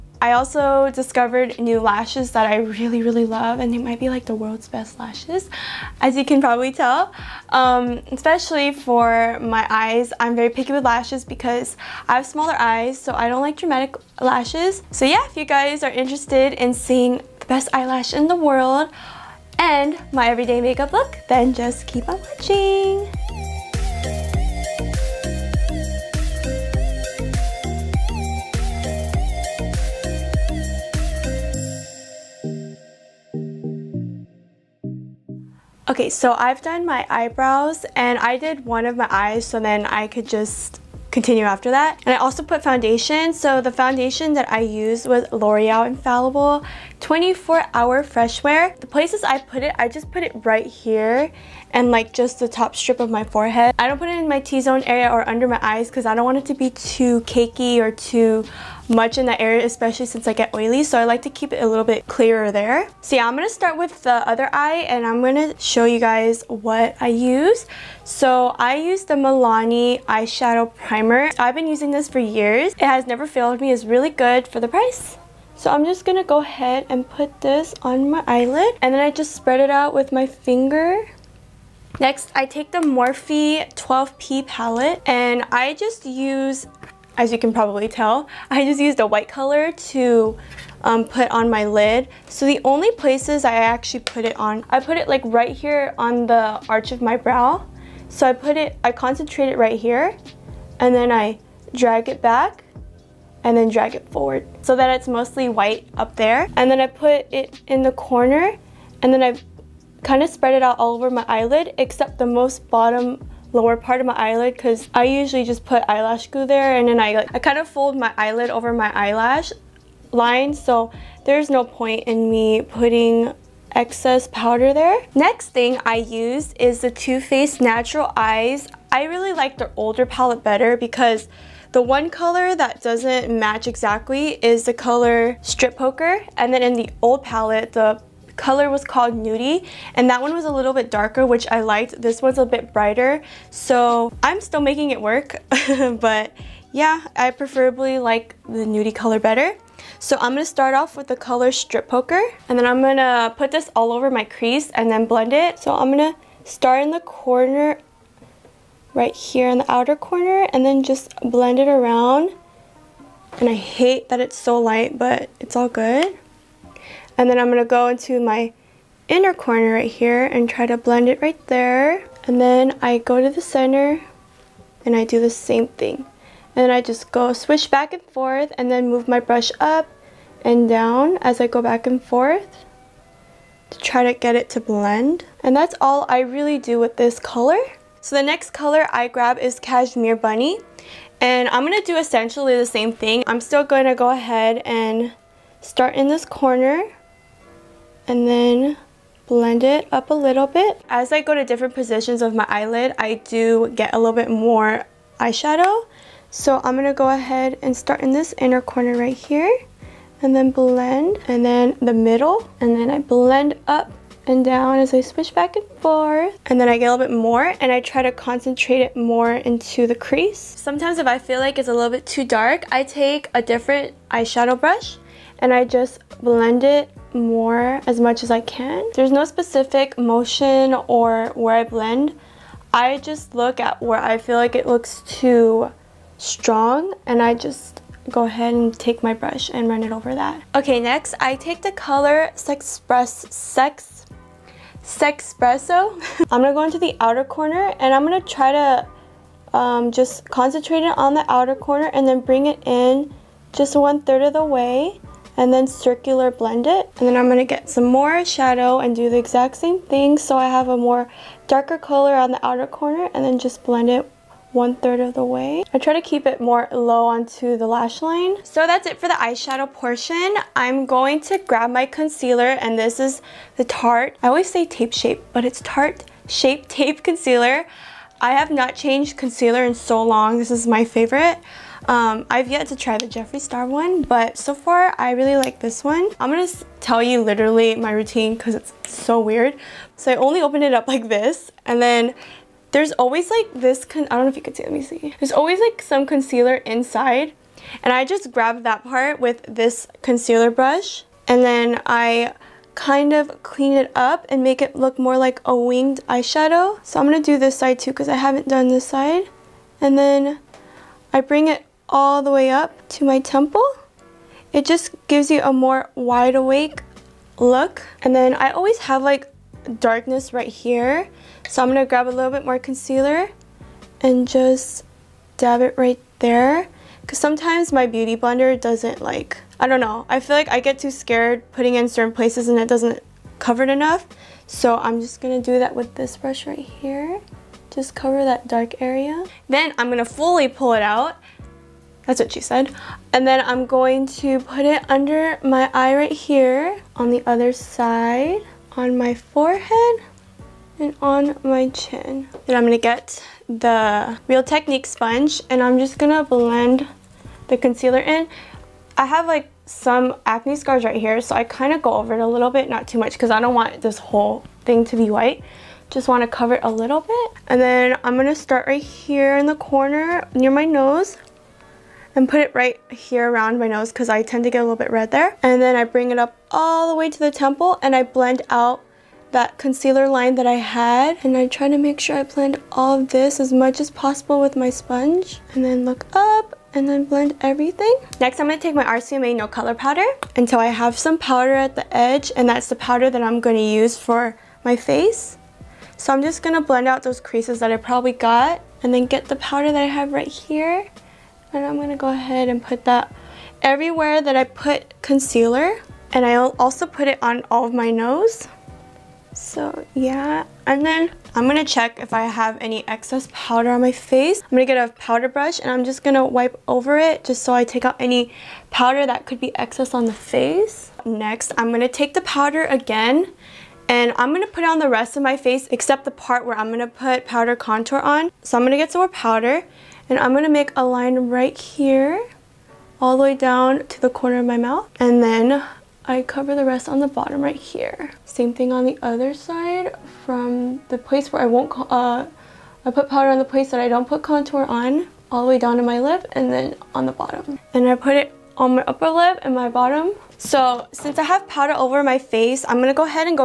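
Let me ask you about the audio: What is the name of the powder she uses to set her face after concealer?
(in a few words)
RCMA No Color Powder.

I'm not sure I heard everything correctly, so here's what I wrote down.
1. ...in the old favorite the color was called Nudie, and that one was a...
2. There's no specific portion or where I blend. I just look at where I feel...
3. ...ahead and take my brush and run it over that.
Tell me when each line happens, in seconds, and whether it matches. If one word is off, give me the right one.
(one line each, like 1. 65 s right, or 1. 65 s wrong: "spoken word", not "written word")
1. 136 s wrong: "palette", not "favorite"
2. 228 s wrong: "motion", not "portion"
3. 238 s right.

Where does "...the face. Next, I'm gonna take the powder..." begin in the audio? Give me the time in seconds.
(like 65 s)
420 s.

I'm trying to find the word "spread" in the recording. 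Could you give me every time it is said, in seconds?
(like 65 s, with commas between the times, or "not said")
79 s, 110 s.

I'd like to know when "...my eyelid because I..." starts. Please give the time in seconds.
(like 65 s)
114 s.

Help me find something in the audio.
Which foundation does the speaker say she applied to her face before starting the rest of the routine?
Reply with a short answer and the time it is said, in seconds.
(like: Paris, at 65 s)
L'Oreal Infallible 24 Hour Fresh Wear, at 45 s.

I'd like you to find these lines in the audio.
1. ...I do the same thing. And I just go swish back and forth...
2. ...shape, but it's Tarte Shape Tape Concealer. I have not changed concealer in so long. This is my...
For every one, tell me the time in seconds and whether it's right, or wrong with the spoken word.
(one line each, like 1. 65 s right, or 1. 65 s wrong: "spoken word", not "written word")
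1. 174 s right
2. 274 s right.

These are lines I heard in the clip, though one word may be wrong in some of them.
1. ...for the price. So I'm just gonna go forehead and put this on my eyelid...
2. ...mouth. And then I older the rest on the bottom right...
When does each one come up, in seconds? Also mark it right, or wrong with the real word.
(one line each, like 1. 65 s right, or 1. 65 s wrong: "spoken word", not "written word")
1. 74 s wrong: "ahead", not "forehead"
2. 434 s wrong: "cover", not "older".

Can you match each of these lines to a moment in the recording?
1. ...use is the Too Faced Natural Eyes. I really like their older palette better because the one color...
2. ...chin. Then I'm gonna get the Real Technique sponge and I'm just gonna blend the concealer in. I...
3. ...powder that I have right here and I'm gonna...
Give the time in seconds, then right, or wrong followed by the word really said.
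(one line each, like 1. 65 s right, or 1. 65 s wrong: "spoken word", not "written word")
1. 125 s right
2. 351 s right
3. 399 s right.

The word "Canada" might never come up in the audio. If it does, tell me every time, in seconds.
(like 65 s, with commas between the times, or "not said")
not said.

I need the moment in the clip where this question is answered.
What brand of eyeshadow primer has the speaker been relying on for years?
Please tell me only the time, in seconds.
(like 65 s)
69 s.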